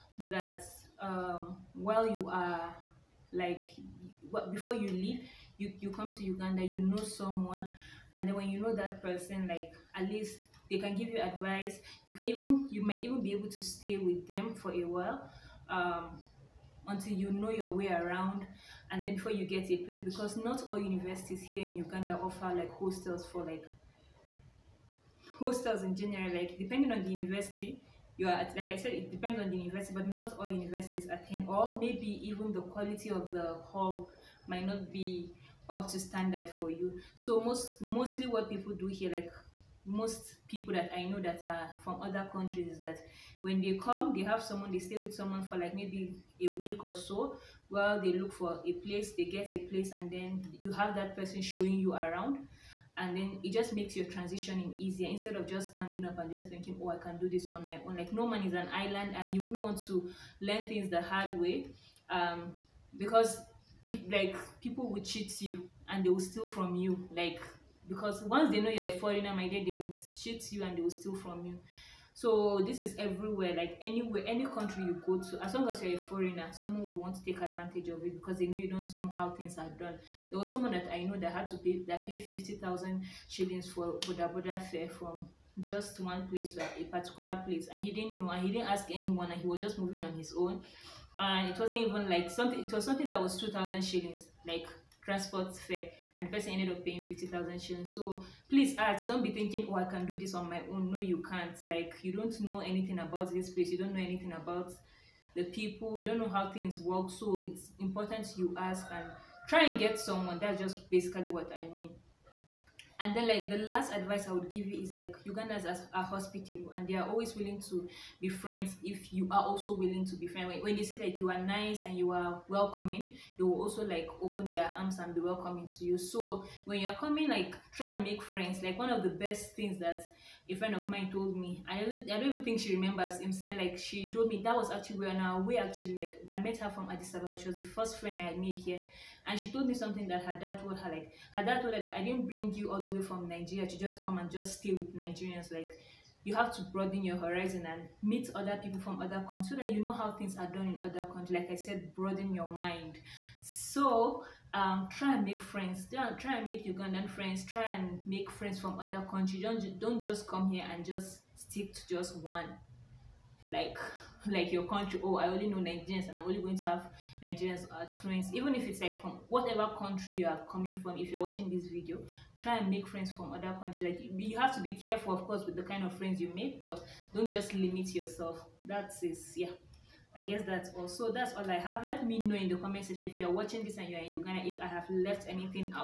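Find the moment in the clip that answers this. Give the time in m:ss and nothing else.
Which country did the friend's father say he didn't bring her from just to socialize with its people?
2:23.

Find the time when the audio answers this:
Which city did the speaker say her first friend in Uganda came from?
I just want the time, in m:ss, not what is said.
2:16.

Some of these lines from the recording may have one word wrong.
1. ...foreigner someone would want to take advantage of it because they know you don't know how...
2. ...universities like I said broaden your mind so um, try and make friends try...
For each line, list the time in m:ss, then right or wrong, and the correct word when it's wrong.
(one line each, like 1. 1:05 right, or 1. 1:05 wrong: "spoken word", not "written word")
1. 1:16 right
2. 2:31 wrong: "countries", not "universities".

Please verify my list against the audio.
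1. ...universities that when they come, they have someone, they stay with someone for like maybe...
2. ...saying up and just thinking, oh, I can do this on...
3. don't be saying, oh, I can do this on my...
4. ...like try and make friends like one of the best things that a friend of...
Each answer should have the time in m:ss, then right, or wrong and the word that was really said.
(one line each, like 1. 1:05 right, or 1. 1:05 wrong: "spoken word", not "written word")
1. 0:42 wrong: "countries", not "universities"
2. 0:55 wrong: "standing", not "saying"
3. 1:39 wrong: "thinking", not "saying"
4. 2:07 right.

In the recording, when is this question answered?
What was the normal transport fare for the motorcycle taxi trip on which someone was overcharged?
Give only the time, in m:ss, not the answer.
1:33.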